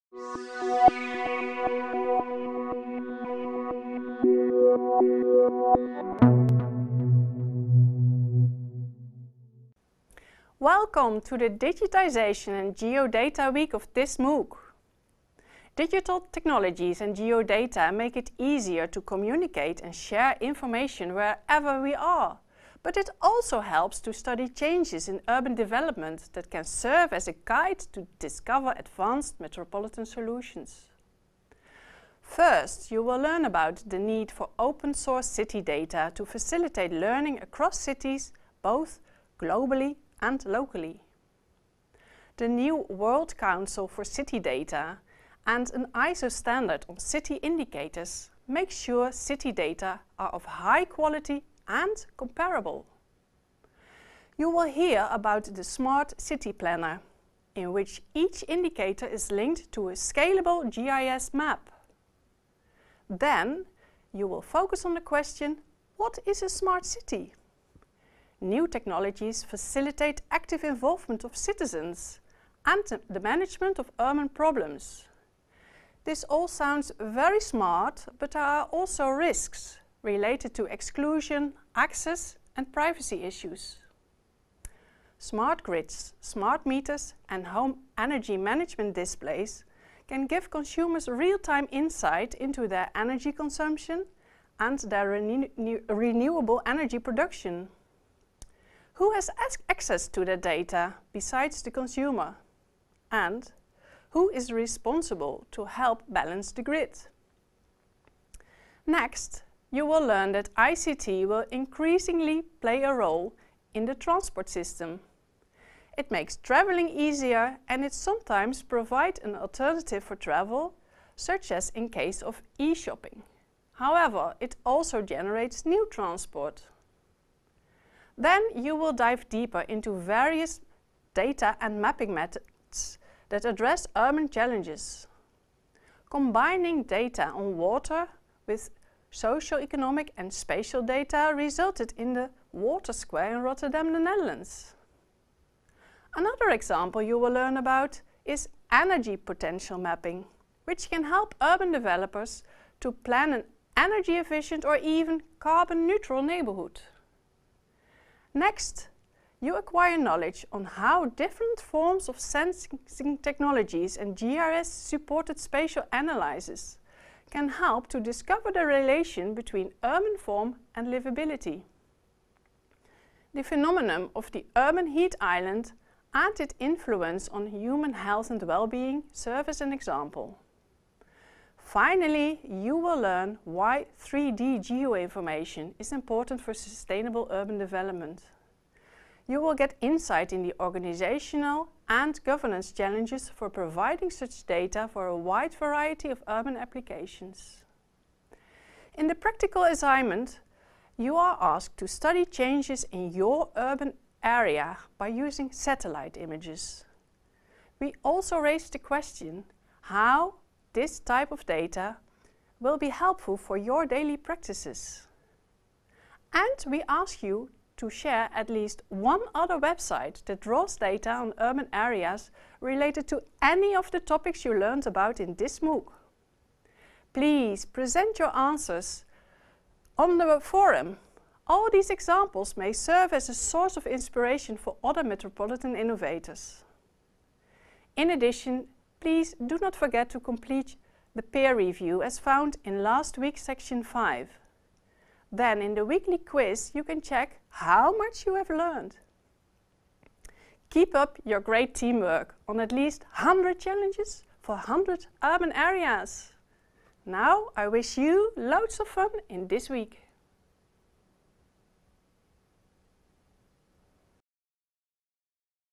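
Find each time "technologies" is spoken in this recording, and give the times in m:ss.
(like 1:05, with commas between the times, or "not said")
0:16, 1:08, 2:43.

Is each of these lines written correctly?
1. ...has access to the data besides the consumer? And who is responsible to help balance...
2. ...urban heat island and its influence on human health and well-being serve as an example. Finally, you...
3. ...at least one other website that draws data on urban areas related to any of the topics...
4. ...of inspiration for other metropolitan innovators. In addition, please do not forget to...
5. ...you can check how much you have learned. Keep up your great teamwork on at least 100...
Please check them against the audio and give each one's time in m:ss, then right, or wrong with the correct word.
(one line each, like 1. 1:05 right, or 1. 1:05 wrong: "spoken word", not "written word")
1. 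1:39 right
2. 2:54 right
3. 3:38 right
4. 3:53 right
5. 4:06 right.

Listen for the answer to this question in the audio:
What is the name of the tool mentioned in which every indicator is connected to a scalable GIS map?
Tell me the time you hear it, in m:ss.
0:55.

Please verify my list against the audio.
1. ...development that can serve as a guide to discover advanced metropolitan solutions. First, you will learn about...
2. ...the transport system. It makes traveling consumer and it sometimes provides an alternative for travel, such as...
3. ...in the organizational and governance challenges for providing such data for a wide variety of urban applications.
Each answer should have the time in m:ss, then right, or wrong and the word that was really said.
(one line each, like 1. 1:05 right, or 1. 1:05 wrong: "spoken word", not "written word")
1. 0:25 right
2. 1:53 wrong: "easier", not "consumer"
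3. 3:10 right.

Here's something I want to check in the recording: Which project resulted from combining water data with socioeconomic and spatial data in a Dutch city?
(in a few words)
Water Square.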